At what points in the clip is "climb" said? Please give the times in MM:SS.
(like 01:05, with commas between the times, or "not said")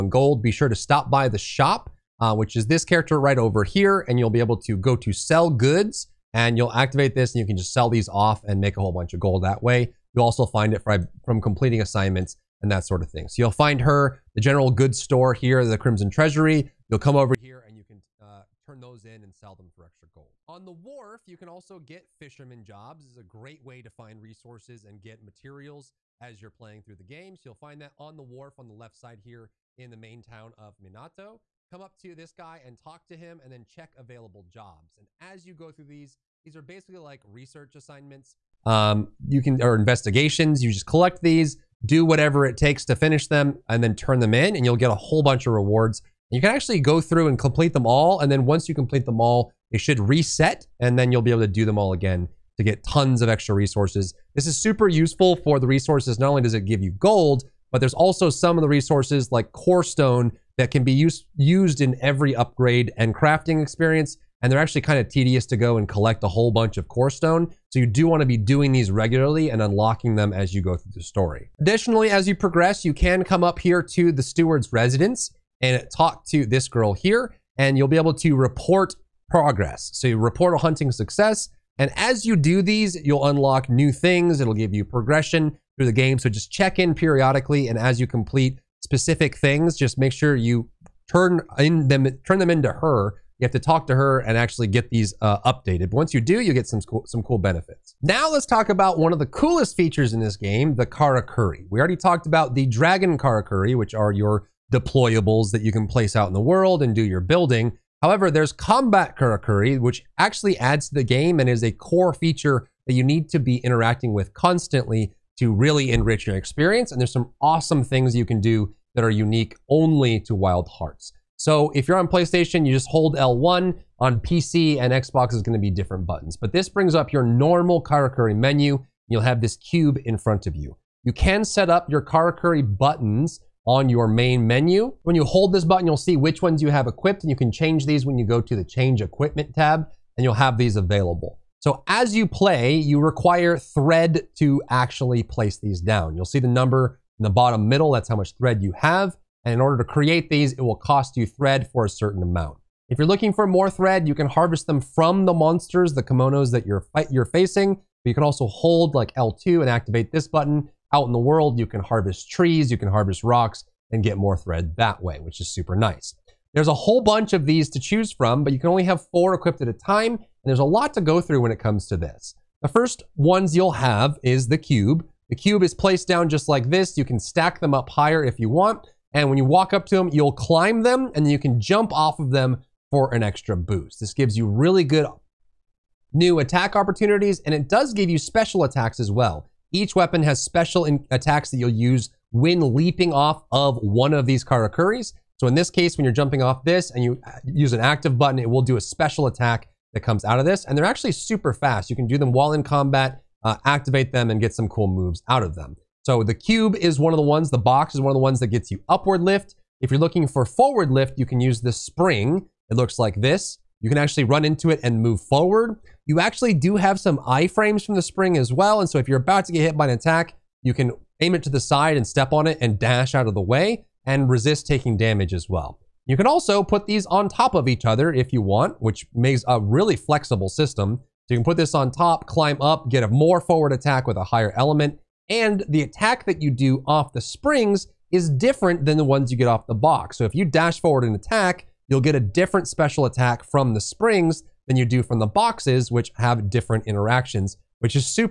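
03:00, 03:52.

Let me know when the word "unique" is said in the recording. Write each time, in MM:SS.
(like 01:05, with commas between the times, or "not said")
01:59.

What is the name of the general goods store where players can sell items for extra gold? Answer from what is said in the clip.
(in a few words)
Crimson Treasury.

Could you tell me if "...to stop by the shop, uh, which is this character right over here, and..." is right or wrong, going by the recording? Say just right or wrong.
right.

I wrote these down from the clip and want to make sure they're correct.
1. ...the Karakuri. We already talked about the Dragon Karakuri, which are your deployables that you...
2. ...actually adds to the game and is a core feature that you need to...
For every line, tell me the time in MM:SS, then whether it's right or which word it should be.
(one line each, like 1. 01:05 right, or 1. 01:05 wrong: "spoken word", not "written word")
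1. 01:40 right
2. 01:50 right.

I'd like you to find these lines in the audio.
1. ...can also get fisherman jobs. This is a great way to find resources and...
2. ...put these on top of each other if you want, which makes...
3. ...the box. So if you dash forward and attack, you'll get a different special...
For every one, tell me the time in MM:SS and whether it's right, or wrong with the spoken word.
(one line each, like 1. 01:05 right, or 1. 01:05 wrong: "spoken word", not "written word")
1. 00:21 right
2. 03:46 right
3. 03:59 right.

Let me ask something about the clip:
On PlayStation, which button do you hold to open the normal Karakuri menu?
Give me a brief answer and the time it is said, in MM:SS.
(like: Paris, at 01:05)
L1, at 02:03.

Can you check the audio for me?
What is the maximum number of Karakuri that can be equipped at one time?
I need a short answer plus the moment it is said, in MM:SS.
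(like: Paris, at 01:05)
4, at 02:49.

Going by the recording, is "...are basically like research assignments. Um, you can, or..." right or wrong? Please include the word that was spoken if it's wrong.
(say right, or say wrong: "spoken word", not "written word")
right.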